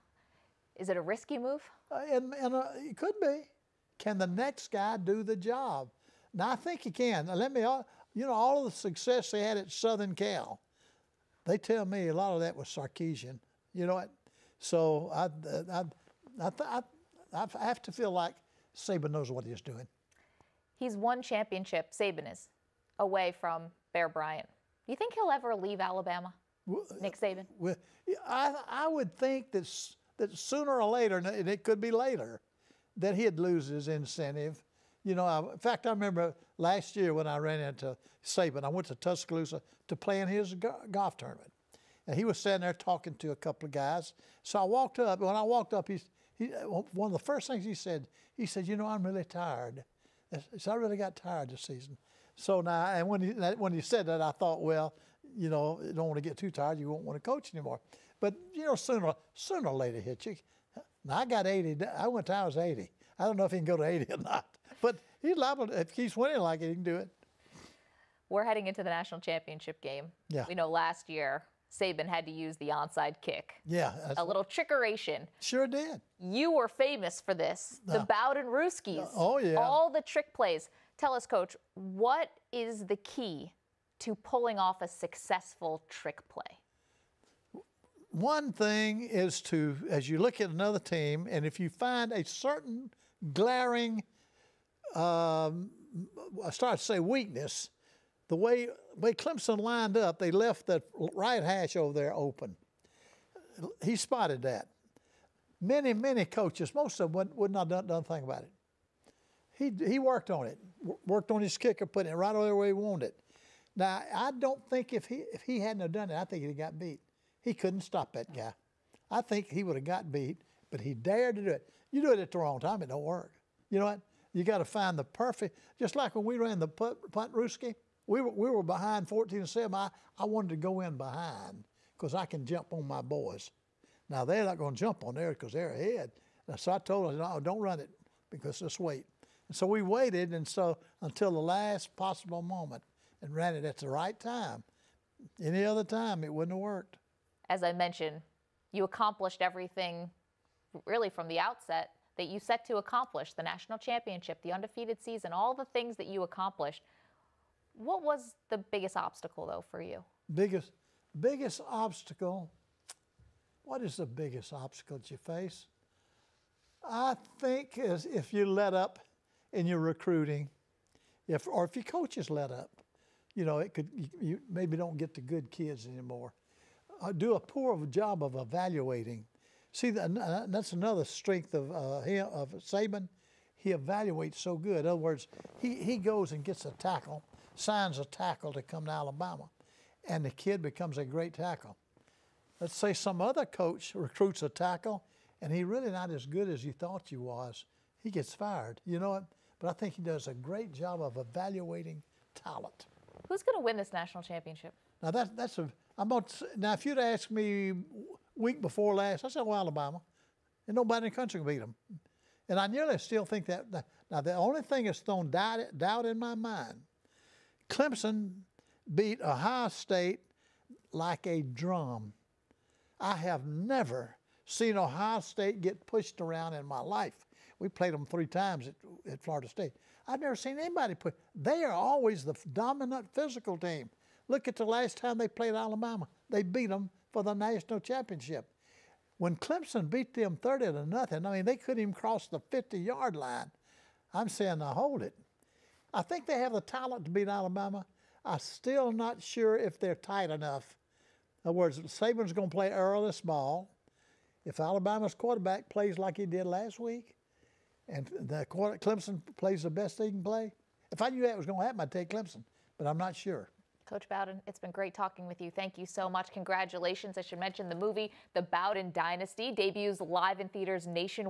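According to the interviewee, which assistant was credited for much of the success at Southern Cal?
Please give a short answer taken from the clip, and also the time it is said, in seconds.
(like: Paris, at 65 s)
Sarkisian, at 12 s.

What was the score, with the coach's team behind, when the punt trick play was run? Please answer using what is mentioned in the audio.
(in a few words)
14 to 7.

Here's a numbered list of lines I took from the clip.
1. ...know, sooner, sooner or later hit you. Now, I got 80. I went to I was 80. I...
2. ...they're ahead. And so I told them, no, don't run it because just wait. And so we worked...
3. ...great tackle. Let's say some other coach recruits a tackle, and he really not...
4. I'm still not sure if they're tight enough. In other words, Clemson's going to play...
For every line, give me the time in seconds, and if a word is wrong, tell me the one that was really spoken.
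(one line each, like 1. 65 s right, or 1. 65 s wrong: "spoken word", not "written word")
1. 58 s right
2. 135 s wrong: "waited", not "worked"
3. 191 s right
4. 248 s wrong: "Saban", not "Clemson".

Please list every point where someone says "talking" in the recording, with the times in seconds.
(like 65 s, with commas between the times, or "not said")
42 s, 264 s.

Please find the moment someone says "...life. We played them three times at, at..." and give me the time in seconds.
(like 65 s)
226 s.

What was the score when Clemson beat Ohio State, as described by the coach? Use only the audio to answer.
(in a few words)
30 to 0.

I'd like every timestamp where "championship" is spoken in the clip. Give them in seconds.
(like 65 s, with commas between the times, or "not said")
21 s, 69 s, 153 s, 204 s, 237 s.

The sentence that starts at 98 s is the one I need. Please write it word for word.
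The way, way Clemson lined up, they left the right hash over there open.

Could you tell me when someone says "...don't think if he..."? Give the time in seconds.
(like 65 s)
114 s.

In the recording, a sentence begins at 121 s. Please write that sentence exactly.
You do it at the wrong time, it don't work.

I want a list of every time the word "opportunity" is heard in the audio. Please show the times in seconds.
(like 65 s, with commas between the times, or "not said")
not said.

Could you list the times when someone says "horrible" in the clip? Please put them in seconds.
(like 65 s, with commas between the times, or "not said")
not said.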